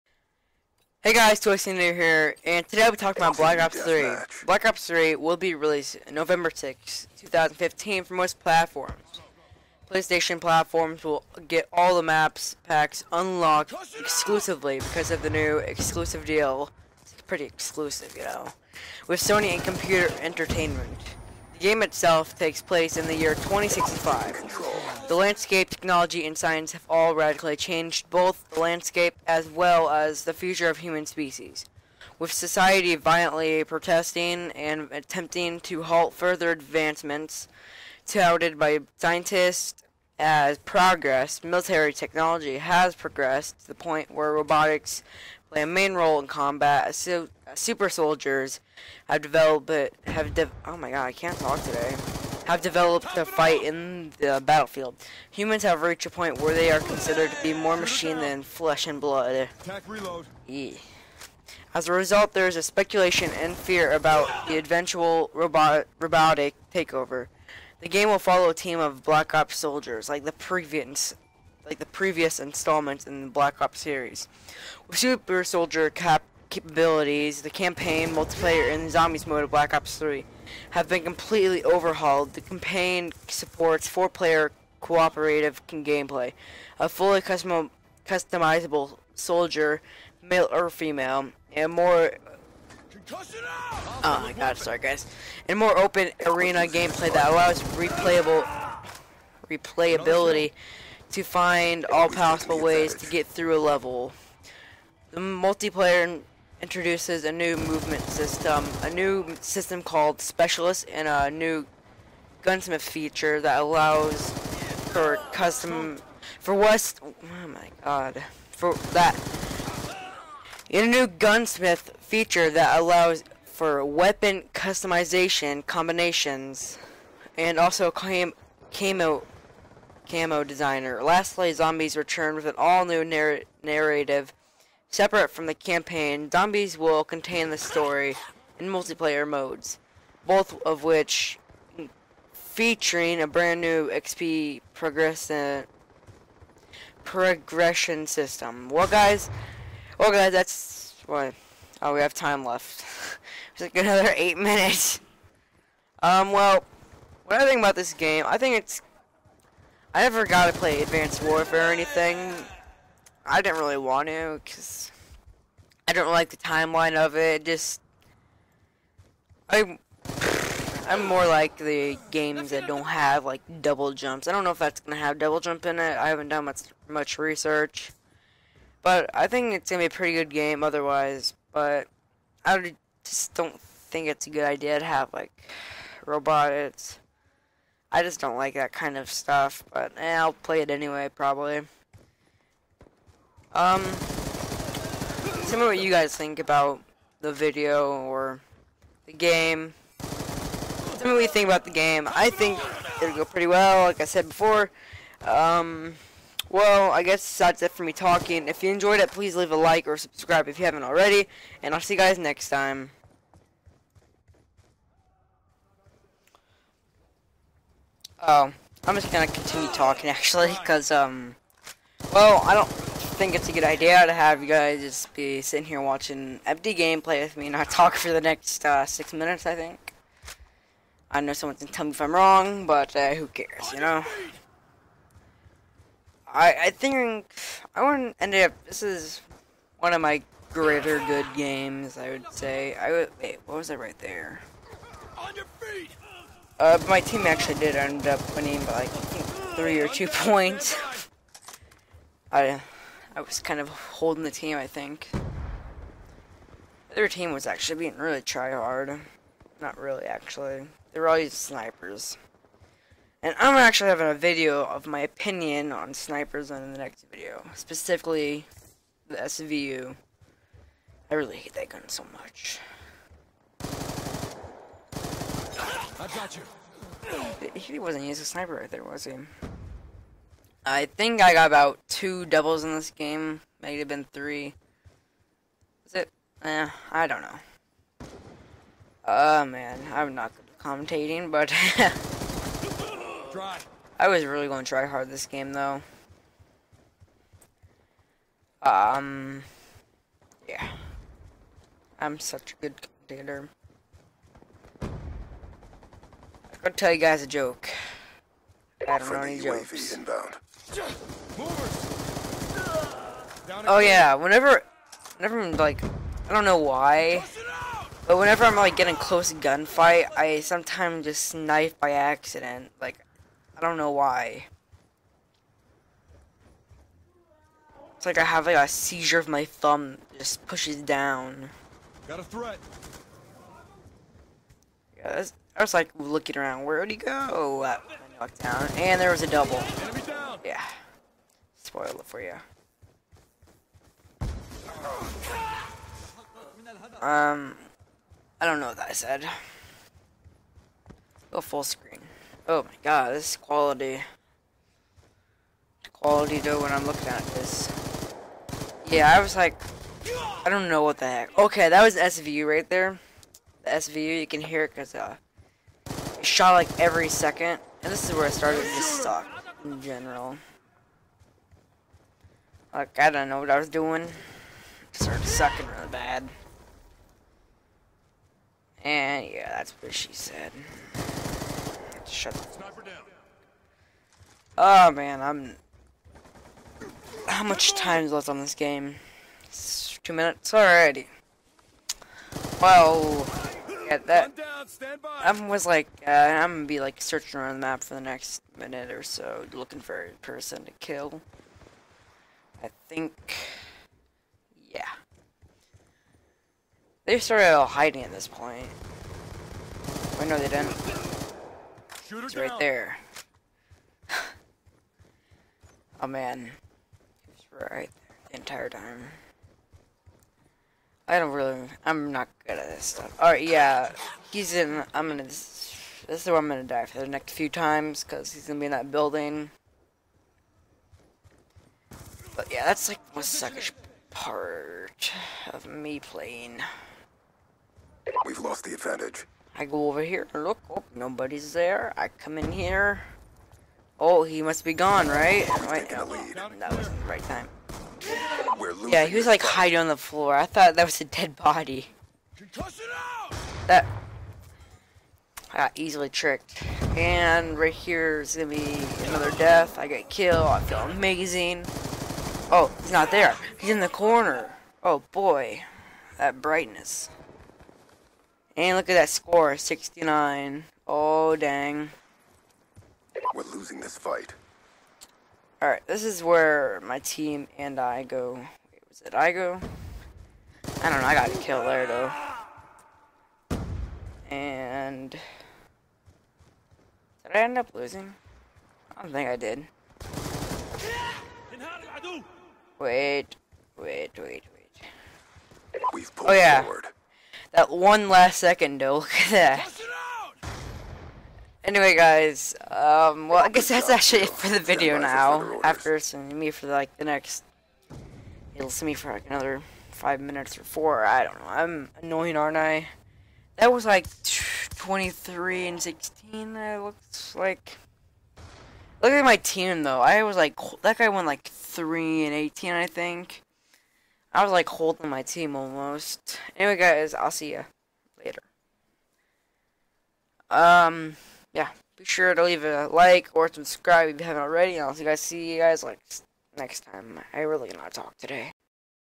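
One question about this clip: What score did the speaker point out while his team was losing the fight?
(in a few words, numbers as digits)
69.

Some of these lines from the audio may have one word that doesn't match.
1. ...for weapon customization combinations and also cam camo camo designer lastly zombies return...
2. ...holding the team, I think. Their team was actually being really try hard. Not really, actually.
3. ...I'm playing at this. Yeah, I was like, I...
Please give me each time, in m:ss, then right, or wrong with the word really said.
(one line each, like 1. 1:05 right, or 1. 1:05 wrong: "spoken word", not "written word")
1. 2:03 right
2. 4:13 right
3. 5:56 wrong: "looking", not "playing".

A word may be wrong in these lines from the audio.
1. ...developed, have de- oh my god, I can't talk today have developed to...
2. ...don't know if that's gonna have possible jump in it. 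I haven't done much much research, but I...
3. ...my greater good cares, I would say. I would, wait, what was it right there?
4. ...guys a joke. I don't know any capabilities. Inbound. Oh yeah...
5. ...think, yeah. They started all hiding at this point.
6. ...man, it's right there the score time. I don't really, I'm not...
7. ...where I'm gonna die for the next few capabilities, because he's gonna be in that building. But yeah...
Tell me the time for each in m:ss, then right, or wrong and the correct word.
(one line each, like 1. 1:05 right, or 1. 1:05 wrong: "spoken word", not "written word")
1. 0:49 right
2. 2:54 wrong: "double", not "possible"
3. 4:00 wrong: "games", not "cares"
4. 5:06 wrong: "jokes", not "capabilities"
5. 6:42 right
6. 6:56 wrong: "entire", not "score"
7. 7:06 wrong: "times", not "capabilities".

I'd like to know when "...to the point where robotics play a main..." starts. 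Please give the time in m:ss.
0:43.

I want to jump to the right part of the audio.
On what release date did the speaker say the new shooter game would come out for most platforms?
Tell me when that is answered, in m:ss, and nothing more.
0:06.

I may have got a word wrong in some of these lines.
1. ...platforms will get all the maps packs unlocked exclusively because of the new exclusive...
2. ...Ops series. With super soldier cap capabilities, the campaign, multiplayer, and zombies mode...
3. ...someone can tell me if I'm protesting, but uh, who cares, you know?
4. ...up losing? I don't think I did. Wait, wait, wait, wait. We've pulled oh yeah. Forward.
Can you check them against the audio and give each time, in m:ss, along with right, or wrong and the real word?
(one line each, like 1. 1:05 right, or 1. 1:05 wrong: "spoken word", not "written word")
1. 0:10 right
2. 1:13 right
3. 3:51 wrong: "wrong", not "protesting"
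4. 8:07 right.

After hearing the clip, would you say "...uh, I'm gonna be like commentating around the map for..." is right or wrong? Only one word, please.
wrong.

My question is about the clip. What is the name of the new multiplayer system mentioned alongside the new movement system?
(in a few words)
Specialist.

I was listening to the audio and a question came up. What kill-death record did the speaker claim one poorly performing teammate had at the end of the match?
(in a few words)
3 and 18.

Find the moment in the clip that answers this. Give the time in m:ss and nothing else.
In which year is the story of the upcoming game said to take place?
0:23.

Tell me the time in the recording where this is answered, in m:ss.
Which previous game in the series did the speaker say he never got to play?
2:40.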